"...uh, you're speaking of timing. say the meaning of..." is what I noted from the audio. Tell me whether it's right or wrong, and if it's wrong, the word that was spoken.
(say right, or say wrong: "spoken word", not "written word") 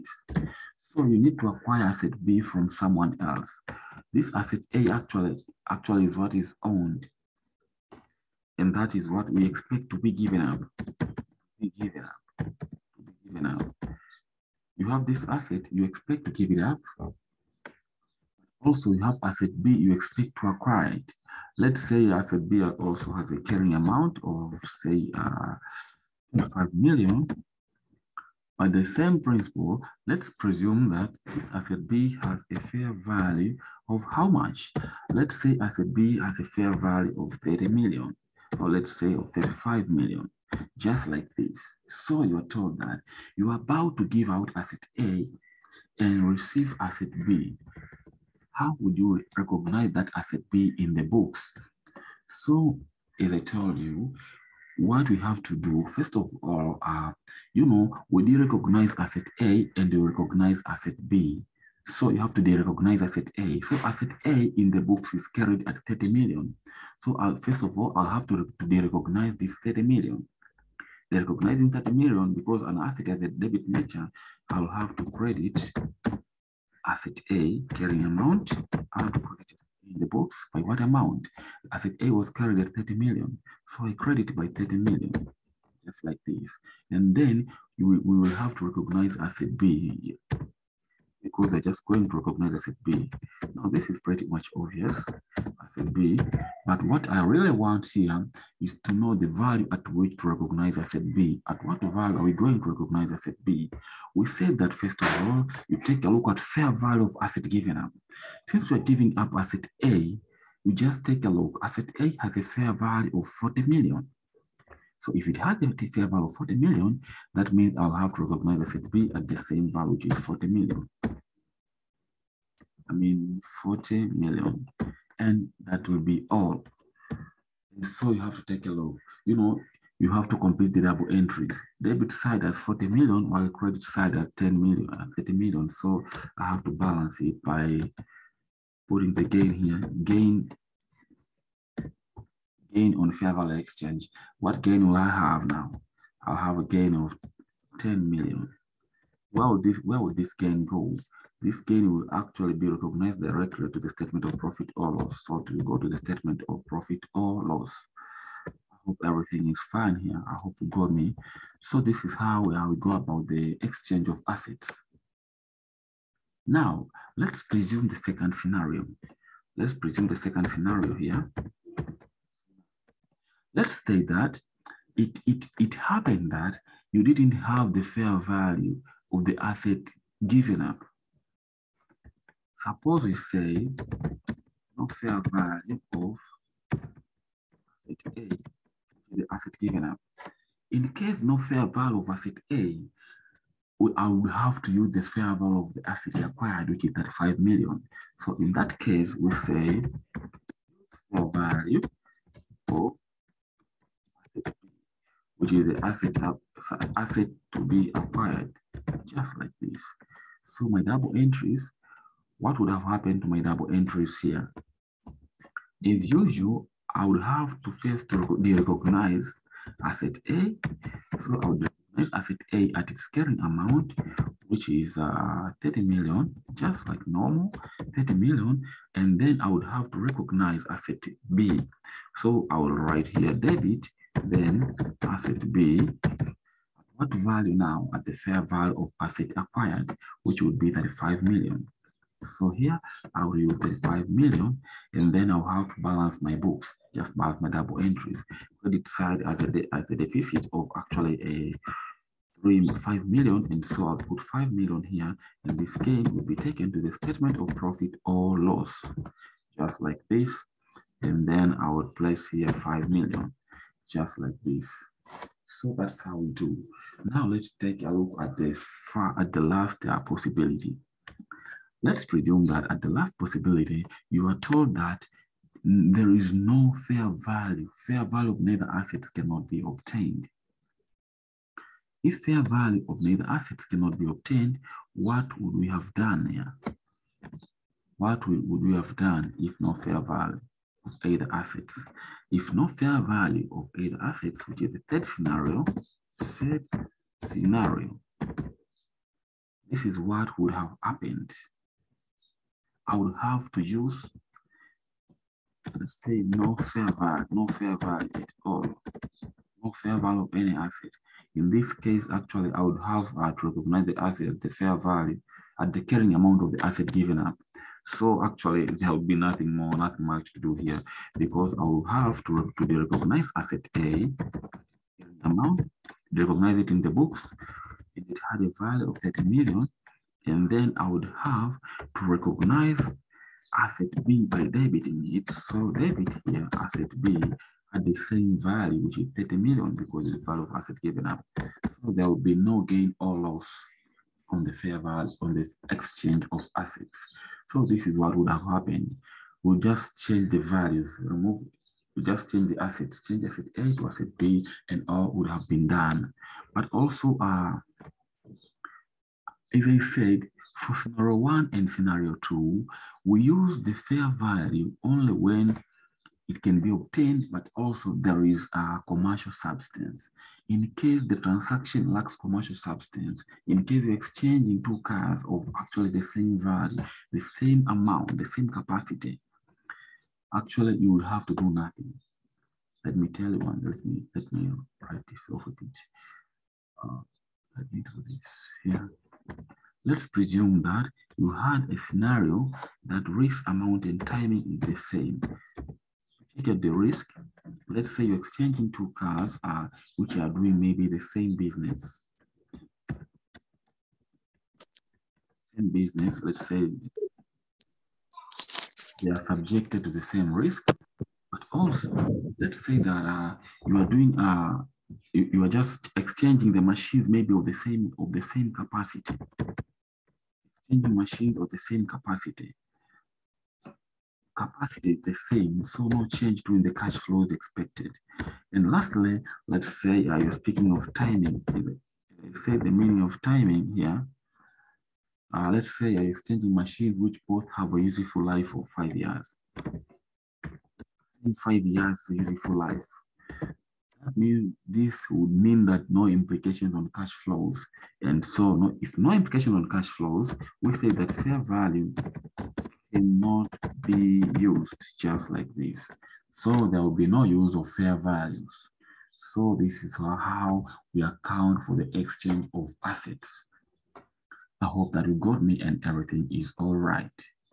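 right.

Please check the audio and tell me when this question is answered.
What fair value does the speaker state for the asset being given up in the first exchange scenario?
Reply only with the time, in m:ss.
1:51.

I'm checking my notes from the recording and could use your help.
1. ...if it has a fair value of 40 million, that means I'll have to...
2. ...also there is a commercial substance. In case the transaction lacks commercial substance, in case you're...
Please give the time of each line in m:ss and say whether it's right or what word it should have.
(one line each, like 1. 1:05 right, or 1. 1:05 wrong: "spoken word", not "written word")
1. 1:55 right
2. 6:07 right.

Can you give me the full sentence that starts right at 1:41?
At what value are we going to recognize asset B?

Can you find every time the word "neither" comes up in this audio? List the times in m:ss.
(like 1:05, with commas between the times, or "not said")
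4:38, 4:43.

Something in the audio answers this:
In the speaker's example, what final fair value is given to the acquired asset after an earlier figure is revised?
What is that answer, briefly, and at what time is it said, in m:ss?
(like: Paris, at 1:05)
35 million, at 0:38.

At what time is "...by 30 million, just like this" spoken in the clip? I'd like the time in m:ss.
1:24.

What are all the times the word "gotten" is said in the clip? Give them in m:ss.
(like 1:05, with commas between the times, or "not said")
not said.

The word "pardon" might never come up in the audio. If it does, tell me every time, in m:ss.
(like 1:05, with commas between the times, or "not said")
not said.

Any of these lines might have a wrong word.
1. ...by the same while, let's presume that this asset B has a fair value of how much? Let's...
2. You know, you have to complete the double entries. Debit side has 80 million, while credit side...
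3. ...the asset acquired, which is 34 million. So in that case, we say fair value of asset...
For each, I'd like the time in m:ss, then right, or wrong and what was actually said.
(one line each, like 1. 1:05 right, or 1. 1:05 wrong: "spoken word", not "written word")
1. 0:28 wrong: "principle", not "while"
2. 2:09 wrong: "40", not "80"
3. 3:15 wrong: "35", not "34".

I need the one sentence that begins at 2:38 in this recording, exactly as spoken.
I hope everything is fine here.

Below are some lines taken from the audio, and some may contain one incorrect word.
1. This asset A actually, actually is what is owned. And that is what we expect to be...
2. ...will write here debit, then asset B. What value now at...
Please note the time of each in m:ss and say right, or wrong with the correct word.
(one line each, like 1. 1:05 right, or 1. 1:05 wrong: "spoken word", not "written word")
1. 0:04 right
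2. 3:52 right.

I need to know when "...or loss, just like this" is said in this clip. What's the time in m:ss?
4:18.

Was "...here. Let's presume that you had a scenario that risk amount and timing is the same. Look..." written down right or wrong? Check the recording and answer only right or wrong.
right.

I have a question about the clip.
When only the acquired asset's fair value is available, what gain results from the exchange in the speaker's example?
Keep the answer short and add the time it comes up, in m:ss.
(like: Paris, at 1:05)
5 million, at 4:13.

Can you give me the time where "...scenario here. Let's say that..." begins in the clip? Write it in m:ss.
2:50.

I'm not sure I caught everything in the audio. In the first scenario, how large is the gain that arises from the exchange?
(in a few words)
10 million.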